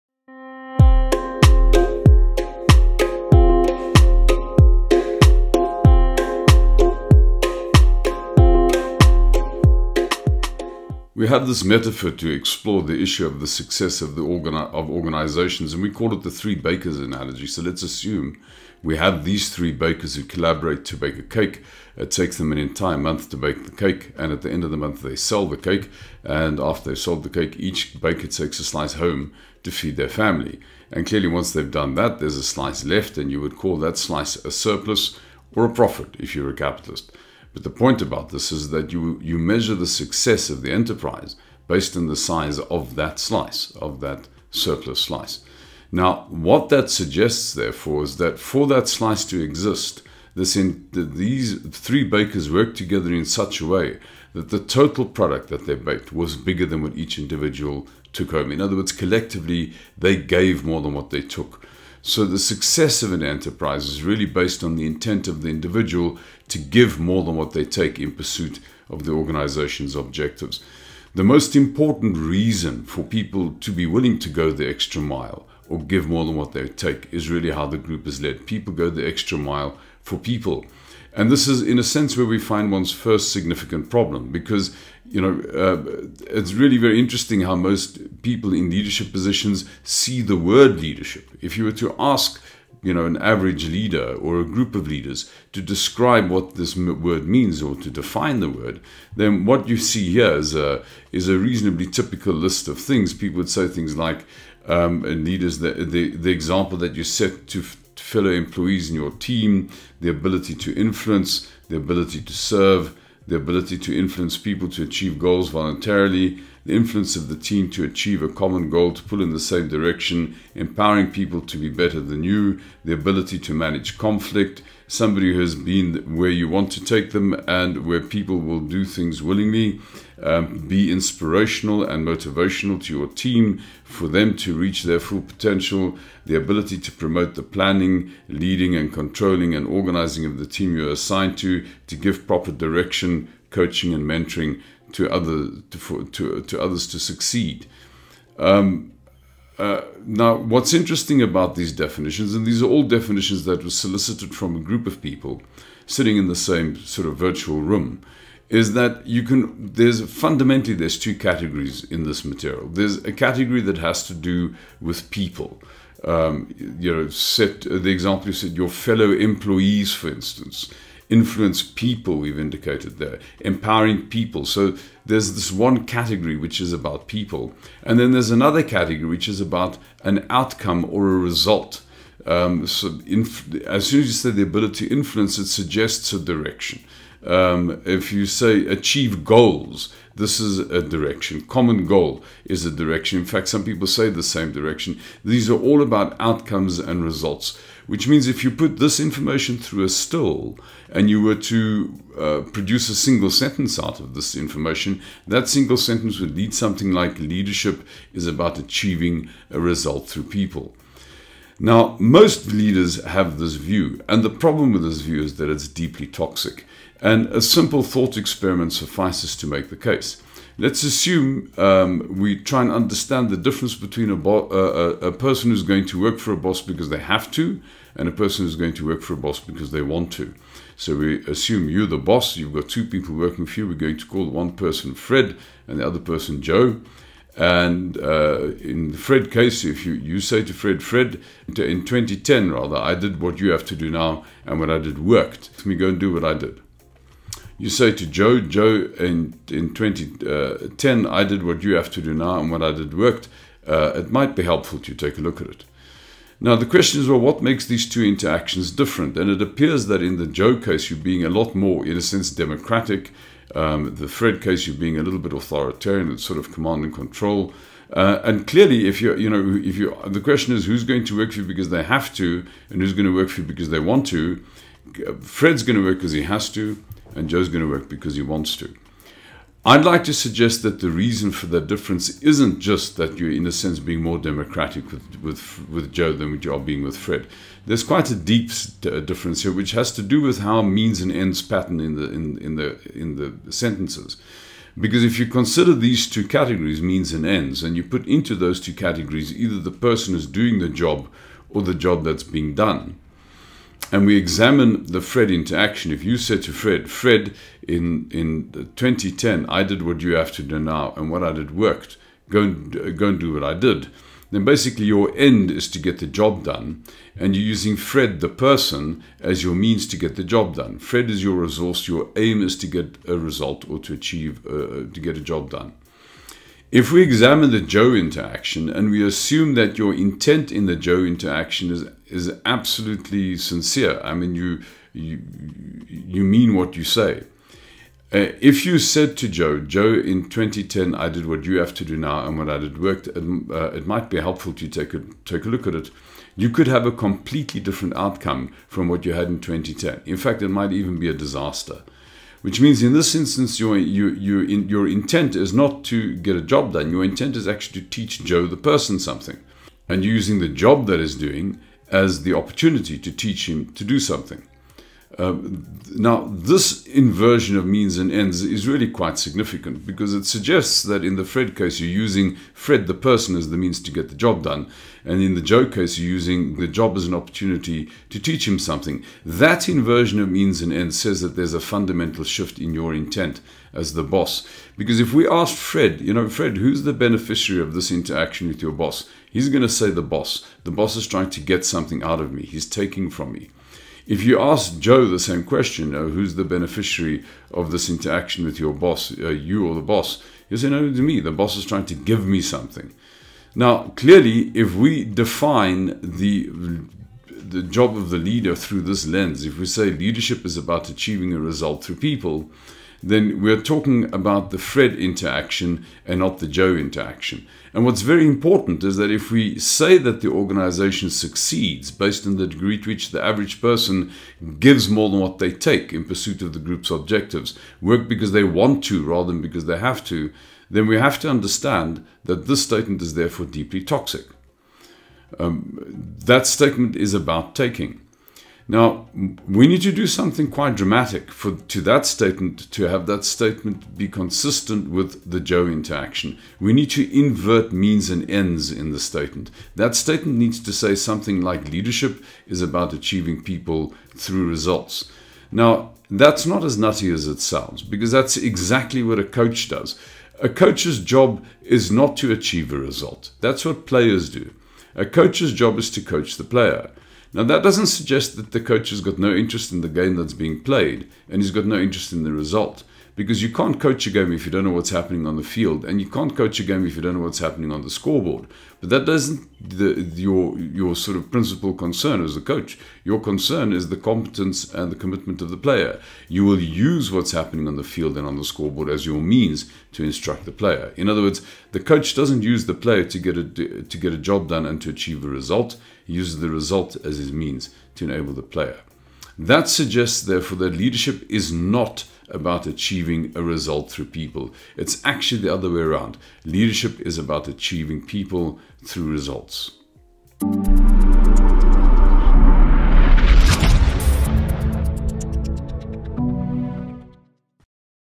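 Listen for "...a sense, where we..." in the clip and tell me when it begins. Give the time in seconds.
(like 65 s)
81 s.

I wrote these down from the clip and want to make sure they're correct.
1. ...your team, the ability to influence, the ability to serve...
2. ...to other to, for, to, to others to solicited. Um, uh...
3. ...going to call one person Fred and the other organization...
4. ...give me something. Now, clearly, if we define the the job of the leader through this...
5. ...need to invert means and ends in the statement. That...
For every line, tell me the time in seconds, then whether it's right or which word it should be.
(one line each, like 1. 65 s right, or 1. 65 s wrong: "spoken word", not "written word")
1. 108 s right
2. 144 s wrong: "succeed", not "solicited"
3. 233 s wrong: "person", not "organization"
4. 401 s right
5. 446 s right.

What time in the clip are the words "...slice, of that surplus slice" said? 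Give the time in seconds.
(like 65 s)
43 s.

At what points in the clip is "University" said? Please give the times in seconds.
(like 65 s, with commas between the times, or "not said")
not said.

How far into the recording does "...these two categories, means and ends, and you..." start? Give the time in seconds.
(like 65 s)
295 s.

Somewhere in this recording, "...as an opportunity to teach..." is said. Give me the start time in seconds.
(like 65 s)
376 s.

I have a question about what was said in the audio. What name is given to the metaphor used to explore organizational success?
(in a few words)
three bakers analogy.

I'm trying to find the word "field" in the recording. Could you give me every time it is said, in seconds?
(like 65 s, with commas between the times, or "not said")
475 s, 487 s.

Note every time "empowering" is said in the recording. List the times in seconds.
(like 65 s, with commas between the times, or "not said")
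120 s, 173 s.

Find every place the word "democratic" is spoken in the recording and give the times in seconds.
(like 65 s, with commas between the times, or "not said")
262 s, 284 s.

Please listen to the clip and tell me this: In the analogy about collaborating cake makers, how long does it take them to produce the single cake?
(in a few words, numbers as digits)
an entire month.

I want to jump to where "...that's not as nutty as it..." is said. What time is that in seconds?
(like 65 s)
456 s.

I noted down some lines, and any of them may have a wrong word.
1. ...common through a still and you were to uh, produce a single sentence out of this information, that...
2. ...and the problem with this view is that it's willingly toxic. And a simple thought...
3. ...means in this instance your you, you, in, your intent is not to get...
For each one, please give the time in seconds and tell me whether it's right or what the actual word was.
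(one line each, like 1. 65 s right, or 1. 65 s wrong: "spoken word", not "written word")
1. 198 s wrong: "information", not "common"
2. 214 s wrong: "deeply", not "willingly"
3. 352 s right.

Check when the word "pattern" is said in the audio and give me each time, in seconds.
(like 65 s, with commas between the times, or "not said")
291 s.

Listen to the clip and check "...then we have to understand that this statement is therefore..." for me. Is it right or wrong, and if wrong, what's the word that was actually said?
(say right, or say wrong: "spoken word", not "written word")
right.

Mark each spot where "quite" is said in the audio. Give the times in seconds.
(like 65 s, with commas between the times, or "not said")
287 s, 368 s, 440 s.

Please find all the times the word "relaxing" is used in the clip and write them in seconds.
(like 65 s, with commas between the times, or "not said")
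not said.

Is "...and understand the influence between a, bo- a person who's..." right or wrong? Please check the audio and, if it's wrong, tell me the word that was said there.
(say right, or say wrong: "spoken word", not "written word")
wrong: "difference", not "influence".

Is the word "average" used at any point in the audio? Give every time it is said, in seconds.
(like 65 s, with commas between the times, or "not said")
93 s, 423 s.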